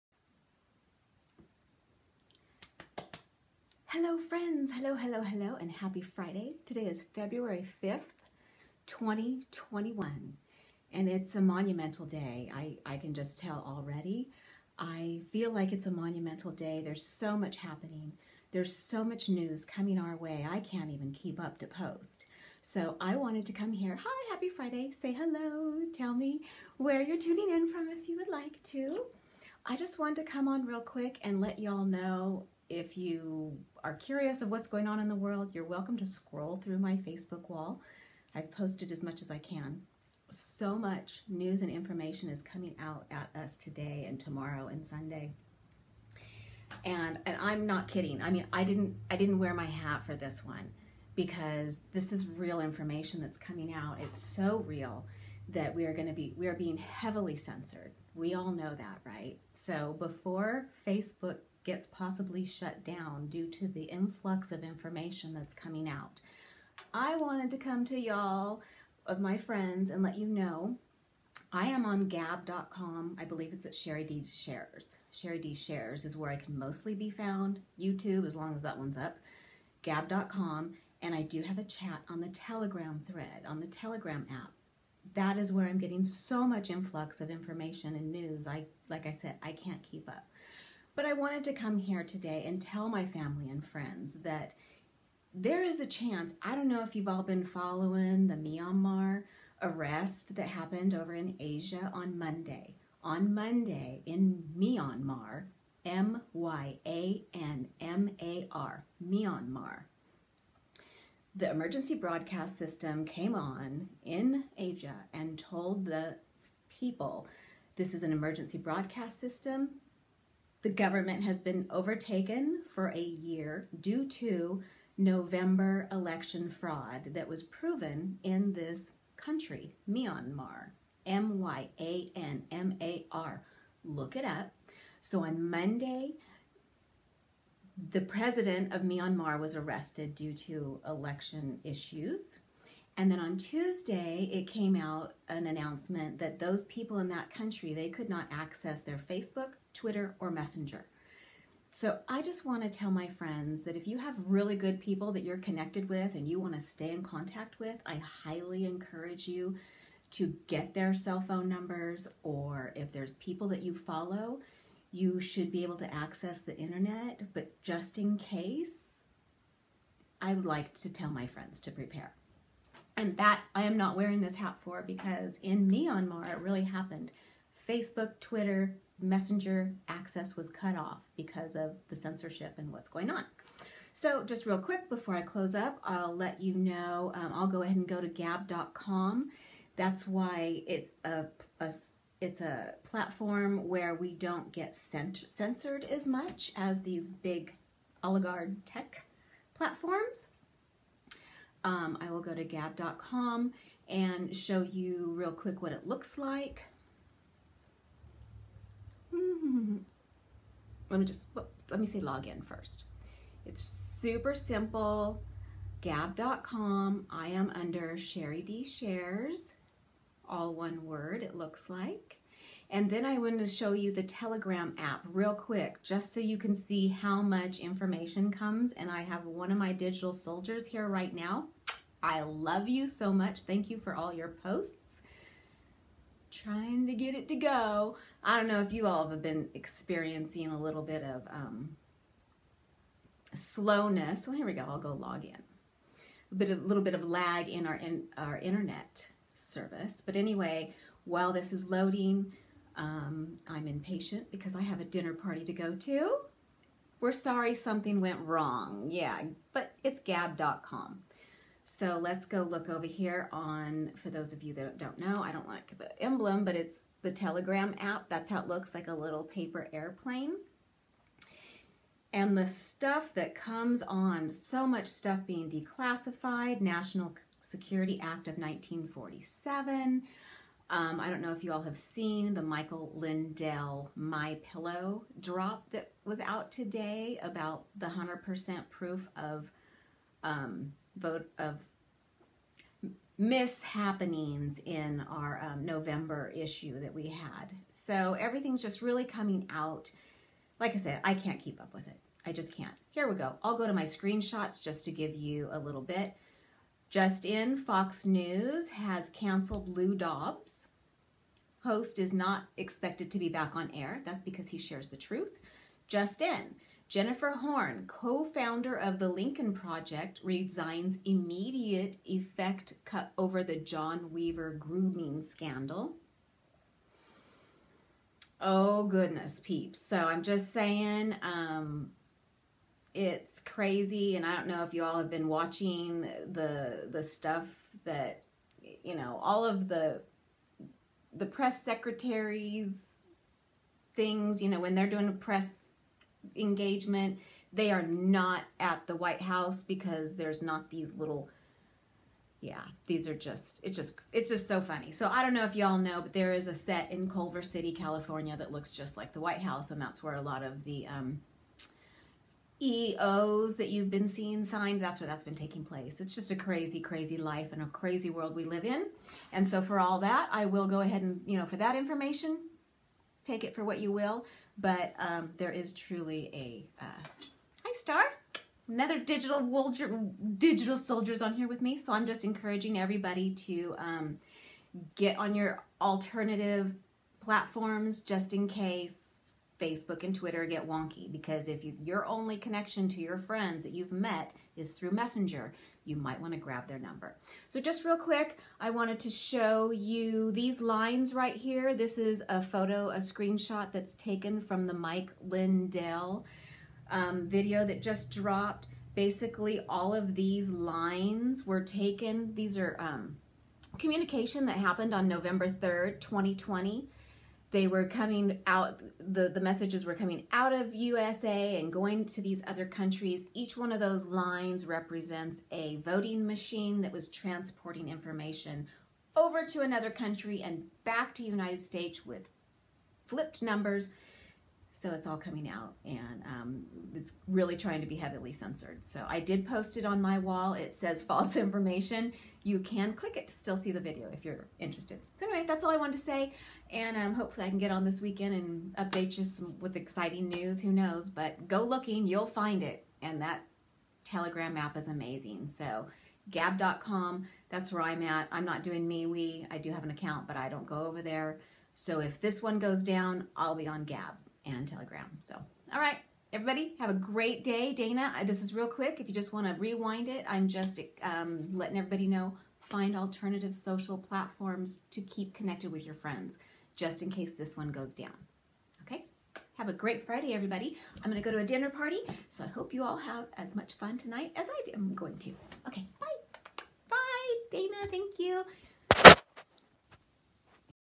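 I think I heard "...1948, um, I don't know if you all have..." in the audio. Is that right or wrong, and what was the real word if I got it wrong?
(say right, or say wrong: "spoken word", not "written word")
wrong: "1947", not "1948".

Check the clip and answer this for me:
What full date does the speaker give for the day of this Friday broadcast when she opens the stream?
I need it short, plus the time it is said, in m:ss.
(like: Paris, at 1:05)
February 5th, 2021, at 0:07.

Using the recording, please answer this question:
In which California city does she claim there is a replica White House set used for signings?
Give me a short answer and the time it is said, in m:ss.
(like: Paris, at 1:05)
Culver City, at 5:57.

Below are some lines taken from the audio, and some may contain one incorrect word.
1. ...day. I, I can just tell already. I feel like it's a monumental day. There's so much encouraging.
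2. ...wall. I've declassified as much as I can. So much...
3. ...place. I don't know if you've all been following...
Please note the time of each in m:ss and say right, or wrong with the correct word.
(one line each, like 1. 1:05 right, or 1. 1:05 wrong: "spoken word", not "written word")
1. 0:12 wrong: "happening", not "encouraging"
2. 0:37 wrong: "posted", not "declassified"
3. 1:35 wrong: "chance", not "place".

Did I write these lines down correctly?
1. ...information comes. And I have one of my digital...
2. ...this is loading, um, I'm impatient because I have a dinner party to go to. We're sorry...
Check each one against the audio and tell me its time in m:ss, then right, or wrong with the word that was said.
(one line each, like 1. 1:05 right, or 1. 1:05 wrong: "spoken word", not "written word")
1. 3:47 right
2. 4:11 right.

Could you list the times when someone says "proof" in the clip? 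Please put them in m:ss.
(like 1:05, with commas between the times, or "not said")
4:48.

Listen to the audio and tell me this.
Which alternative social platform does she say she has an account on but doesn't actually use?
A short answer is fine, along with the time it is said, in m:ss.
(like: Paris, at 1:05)
MeWe, at 7:38.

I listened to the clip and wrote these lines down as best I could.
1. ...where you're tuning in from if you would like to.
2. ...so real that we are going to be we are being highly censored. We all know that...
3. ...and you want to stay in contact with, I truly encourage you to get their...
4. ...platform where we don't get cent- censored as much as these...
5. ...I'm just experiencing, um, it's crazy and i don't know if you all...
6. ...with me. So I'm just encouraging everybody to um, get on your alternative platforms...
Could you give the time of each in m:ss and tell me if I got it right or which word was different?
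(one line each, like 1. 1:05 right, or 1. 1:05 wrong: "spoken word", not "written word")
1. 0:26 right
2. 0:54 wrong: "heavily", not "highly"
3. 2:36 wrong: "highly", not "truly"
4. 3:12 right
5. 5:29 wrong: "saying", not "experiencing"
6. 6:21 right.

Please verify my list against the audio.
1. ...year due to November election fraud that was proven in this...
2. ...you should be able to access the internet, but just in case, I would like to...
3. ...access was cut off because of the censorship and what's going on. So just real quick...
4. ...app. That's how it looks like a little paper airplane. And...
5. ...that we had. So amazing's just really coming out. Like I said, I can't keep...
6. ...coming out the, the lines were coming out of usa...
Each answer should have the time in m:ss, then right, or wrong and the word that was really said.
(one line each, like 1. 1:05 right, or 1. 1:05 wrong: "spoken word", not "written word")
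1. 2:02 right
2. 2:44 right
3. 2:59 right
4. 4:27 right
5. 4:56 wrong: "everything", not "amazing"
6. 6:57 wrong: "messages", not "lines".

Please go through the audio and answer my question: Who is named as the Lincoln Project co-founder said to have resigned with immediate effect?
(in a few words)
Jennifer Horn.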